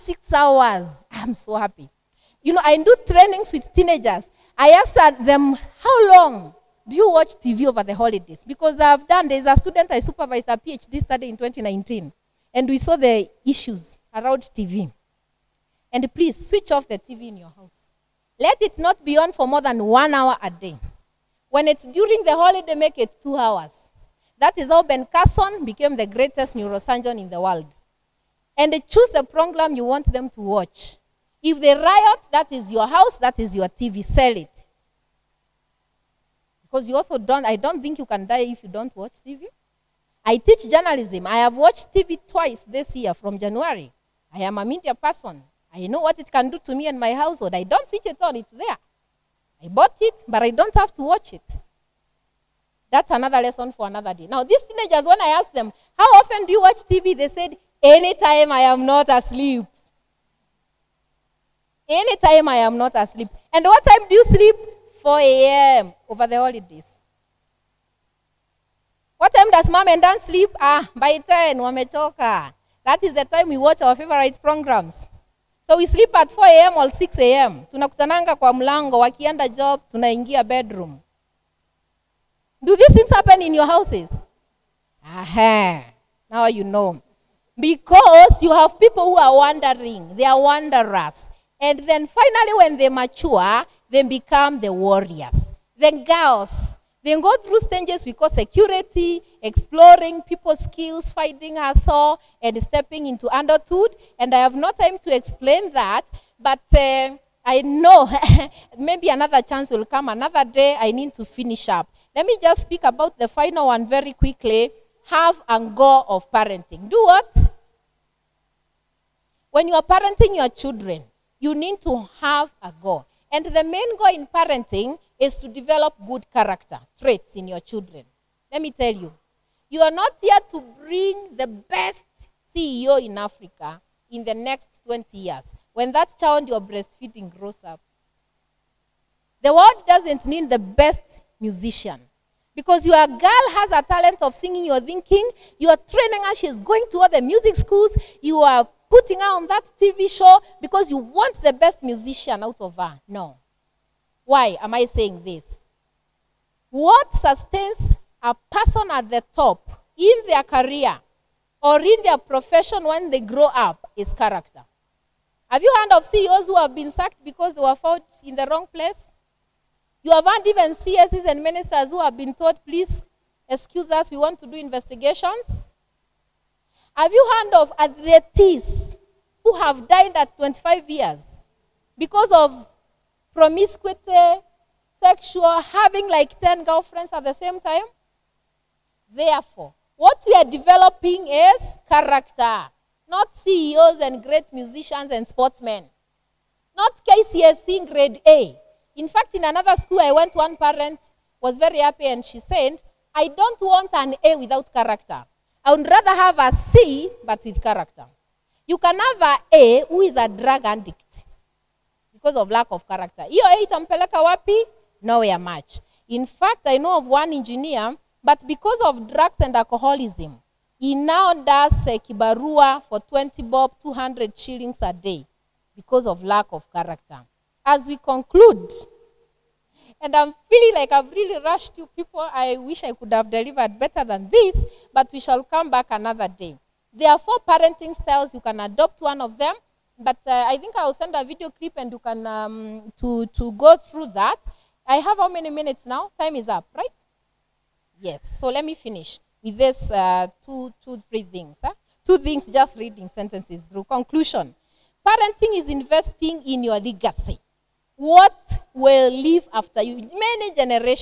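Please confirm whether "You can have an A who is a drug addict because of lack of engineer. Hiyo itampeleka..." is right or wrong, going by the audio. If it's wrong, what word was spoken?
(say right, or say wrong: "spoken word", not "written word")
wrong: "character", not "engineer".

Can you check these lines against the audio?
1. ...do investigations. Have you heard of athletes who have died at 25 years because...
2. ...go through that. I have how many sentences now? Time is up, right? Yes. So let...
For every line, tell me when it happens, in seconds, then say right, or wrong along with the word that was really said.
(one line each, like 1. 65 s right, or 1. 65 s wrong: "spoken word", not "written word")
1. 174 s right
2. 243 s wrong: "minutes", not "sentences".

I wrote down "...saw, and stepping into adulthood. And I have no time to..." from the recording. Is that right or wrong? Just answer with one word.
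right.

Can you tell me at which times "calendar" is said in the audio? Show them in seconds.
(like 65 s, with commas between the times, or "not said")
not said.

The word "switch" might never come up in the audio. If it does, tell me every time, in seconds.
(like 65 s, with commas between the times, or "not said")
16 s, 47 s.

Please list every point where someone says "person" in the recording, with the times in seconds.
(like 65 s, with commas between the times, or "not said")
44 s, 158 s.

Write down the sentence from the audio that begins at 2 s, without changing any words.
You know, I do trainings with teenagers.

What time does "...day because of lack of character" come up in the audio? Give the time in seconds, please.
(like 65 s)
224 s.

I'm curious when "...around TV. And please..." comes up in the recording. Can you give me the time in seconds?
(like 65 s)
14 s.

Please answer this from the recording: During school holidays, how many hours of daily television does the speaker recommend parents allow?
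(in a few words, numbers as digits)
2 hours.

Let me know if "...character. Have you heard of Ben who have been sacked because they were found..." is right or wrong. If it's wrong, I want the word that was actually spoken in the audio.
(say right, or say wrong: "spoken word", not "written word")
wrong: "CEOs", not "Ben".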